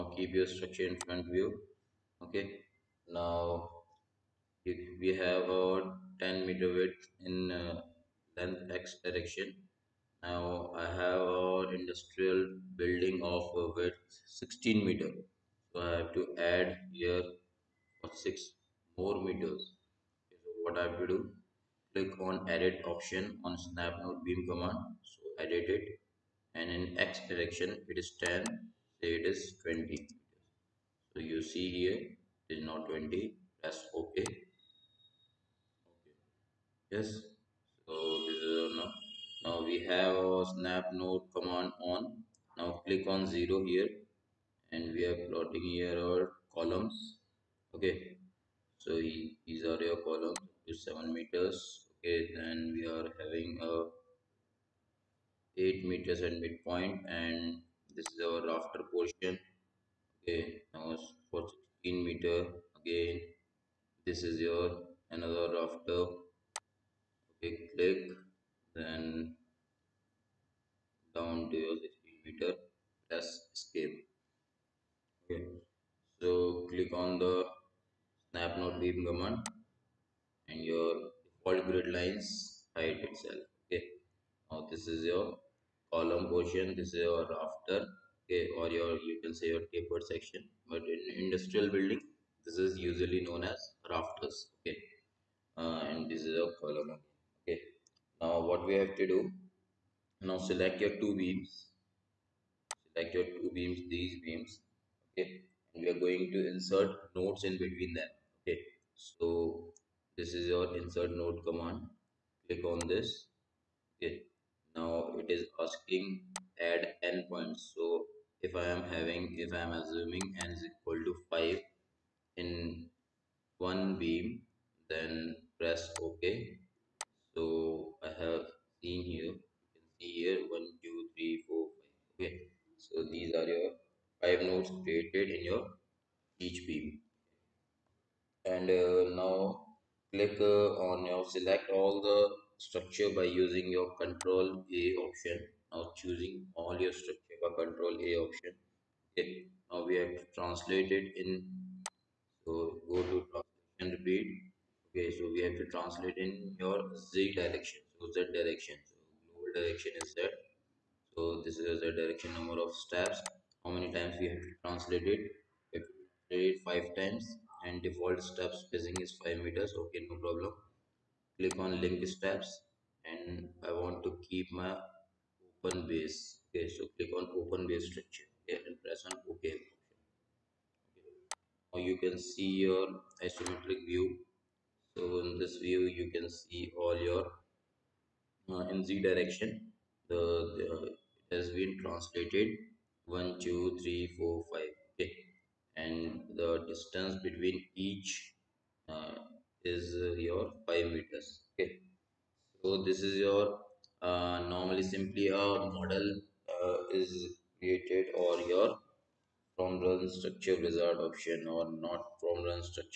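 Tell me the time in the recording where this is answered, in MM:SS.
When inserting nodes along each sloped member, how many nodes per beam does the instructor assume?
02:00.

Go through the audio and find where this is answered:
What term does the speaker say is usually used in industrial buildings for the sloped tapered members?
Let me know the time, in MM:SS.
01:33.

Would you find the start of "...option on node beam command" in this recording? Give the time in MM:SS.
00:22.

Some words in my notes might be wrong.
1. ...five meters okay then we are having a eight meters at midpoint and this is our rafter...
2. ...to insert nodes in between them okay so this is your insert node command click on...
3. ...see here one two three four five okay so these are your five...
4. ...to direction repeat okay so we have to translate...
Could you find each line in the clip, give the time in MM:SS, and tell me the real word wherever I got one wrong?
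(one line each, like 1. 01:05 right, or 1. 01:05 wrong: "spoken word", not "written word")
1. 00:50 wrong: "seven", not "five"
2. 01:46 right
3. 02:09 right
4. 02:33 wrong: "translation", not "direction".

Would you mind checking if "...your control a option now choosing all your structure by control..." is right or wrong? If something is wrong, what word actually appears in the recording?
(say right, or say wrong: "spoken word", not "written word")
right.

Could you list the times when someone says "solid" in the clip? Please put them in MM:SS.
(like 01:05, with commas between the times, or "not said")
not said.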